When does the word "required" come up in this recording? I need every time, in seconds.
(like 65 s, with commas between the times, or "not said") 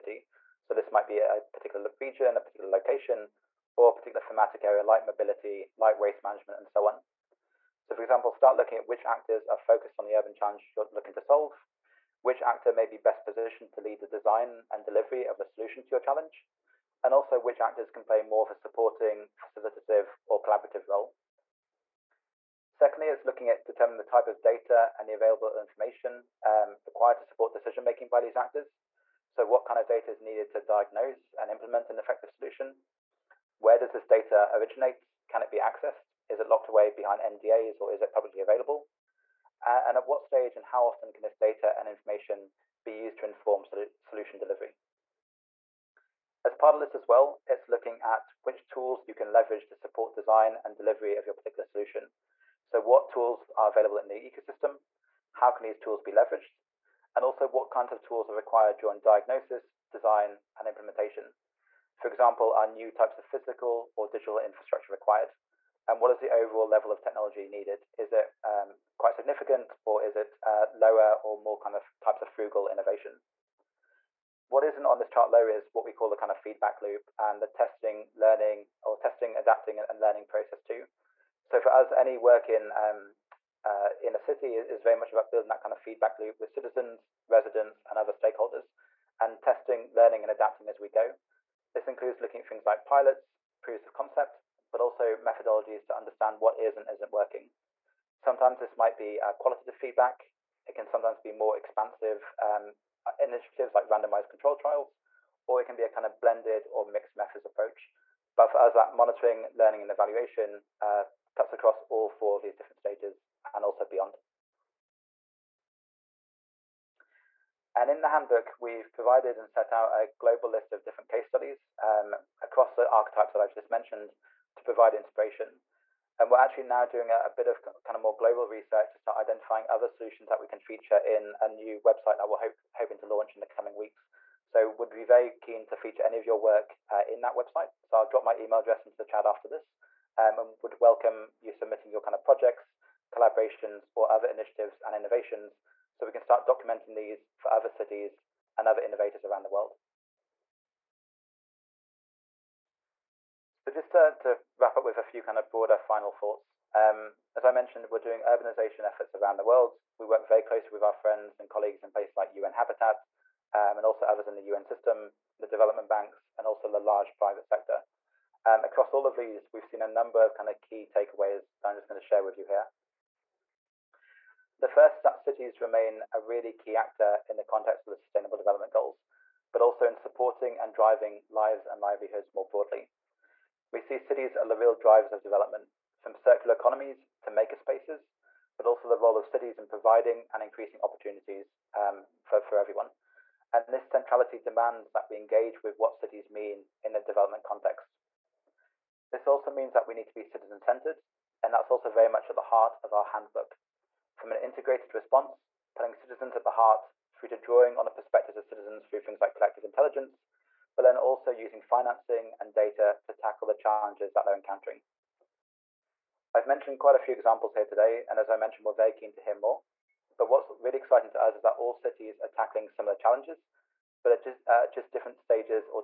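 26 s, 58 s, 64 s.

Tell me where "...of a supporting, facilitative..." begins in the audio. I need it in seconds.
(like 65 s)
18 s.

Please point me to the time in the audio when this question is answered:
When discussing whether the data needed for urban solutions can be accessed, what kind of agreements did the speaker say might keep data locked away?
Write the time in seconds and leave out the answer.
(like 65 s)
37 s.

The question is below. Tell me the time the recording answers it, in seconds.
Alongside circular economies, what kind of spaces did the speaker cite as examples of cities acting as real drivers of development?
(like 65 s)
187 s.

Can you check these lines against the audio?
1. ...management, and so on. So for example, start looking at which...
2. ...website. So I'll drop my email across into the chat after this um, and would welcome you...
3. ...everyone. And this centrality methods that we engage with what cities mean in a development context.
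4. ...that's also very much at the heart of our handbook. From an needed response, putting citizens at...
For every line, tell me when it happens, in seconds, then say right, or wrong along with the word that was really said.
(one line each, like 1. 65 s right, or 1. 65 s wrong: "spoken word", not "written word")
1. 6 s right
2. 137 s wrong: "address", not "across"
3. 192 s wrong: "demands", not "methods"
4. 201 s wrong: "integrated", not "needed".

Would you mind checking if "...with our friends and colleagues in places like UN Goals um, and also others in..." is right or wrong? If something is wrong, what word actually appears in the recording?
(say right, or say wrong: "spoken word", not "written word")
wrong: "Habitat", not "Goals".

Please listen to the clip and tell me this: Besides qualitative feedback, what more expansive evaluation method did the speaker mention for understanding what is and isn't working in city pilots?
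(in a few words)
randomized control trials.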